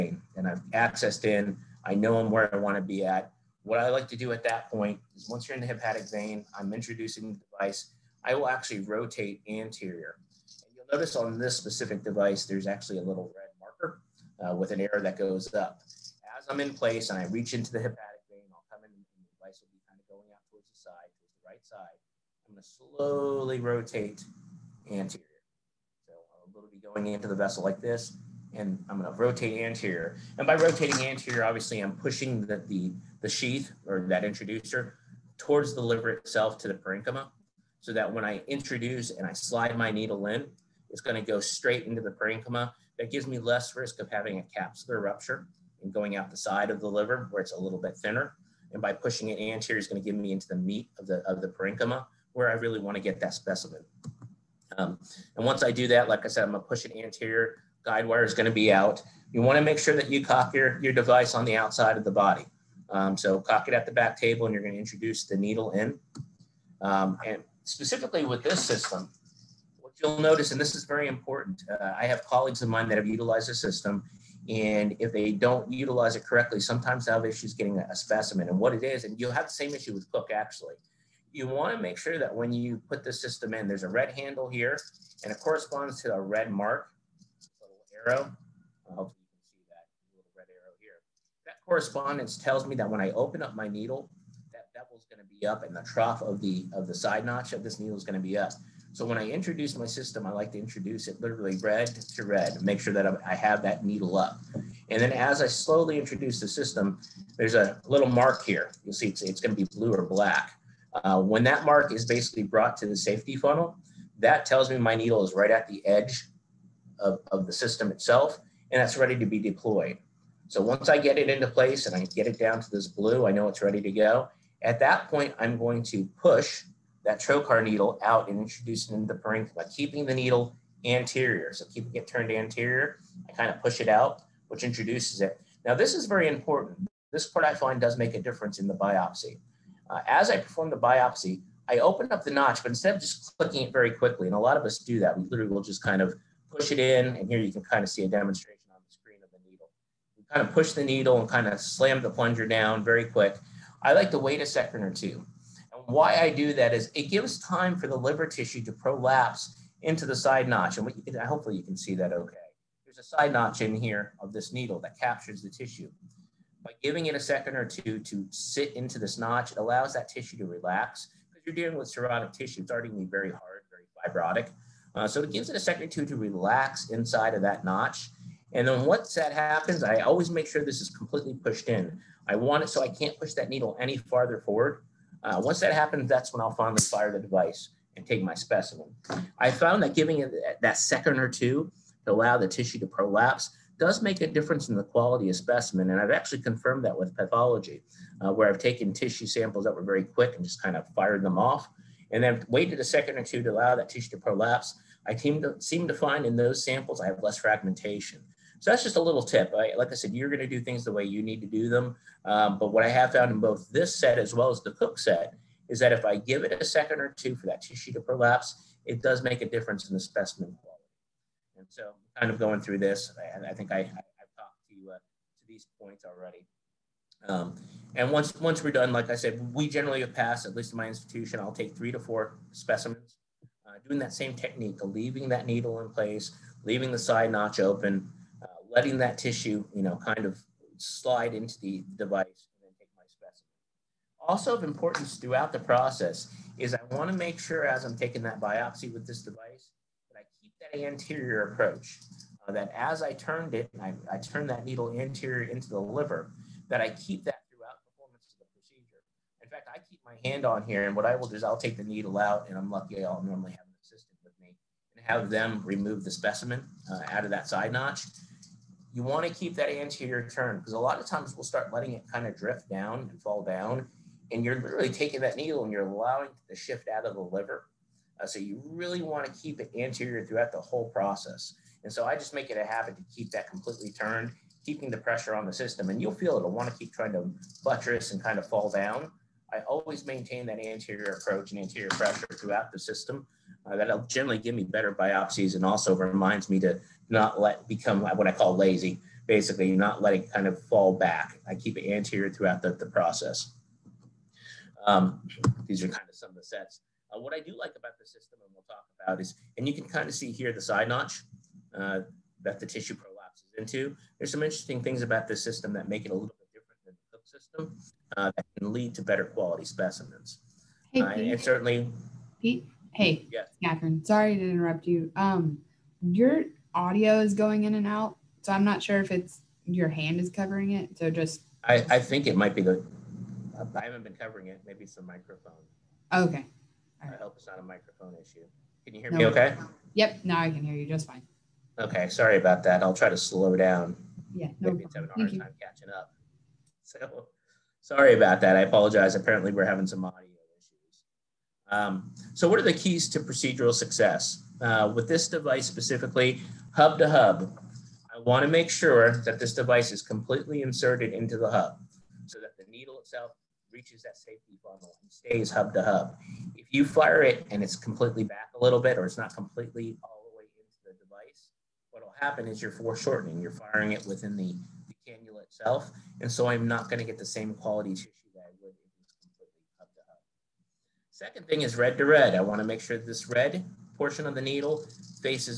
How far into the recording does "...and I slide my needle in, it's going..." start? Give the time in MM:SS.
00:39.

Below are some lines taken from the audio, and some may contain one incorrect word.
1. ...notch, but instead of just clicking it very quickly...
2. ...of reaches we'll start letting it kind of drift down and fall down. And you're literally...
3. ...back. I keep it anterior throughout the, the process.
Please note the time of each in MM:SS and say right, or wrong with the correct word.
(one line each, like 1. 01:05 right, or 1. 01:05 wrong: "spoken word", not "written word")
1. 02:22 right
2. 04:30 wrong: "times", not "reaches"
3. 05:00 right.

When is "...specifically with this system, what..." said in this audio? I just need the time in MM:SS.
01:07.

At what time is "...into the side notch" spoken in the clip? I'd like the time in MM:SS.
02:39.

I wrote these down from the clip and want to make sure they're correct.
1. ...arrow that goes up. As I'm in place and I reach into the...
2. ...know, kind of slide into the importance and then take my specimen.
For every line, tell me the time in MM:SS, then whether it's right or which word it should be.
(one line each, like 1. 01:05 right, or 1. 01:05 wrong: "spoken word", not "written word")
1. 00:14 right
2. 03:59 wrong: "device", not "importance".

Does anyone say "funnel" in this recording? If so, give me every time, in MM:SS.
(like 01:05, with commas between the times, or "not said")
01:53, 06:04.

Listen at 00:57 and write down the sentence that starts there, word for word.
Guide wire is going to be out.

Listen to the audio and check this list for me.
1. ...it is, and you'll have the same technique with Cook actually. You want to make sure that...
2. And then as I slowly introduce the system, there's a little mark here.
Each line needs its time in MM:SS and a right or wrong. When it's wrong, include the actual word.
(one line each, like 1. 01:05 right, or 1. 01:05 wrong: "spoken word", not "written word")
1. 01:18 wrong: "issue", not "technique"
2. 01:44 right.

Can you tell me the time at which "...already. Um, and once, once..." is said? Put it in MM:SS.
03:46.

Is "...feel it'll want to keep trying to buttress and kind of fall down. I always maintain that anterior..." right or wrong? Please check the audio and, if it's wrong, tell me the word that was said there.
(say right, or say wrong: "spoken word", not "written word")
right.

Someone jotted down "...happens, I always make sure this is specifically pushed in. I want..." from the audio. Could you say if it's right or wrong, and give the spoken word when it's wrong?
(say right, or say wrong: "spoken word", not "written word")
wrong: "completely", not "specifically".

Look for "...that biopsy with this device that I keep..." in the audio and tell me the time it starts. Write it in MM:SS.
04:08.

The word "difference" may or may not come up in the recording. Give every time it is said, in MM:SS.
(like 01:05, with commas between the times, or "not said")
02:18, 03:14, 03:39.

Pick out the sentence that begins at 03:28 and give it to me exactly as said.
So that's just a little tip.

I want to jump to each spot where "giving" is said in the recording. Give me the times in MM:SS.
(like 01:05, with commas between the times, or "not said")
02:46, 03:09.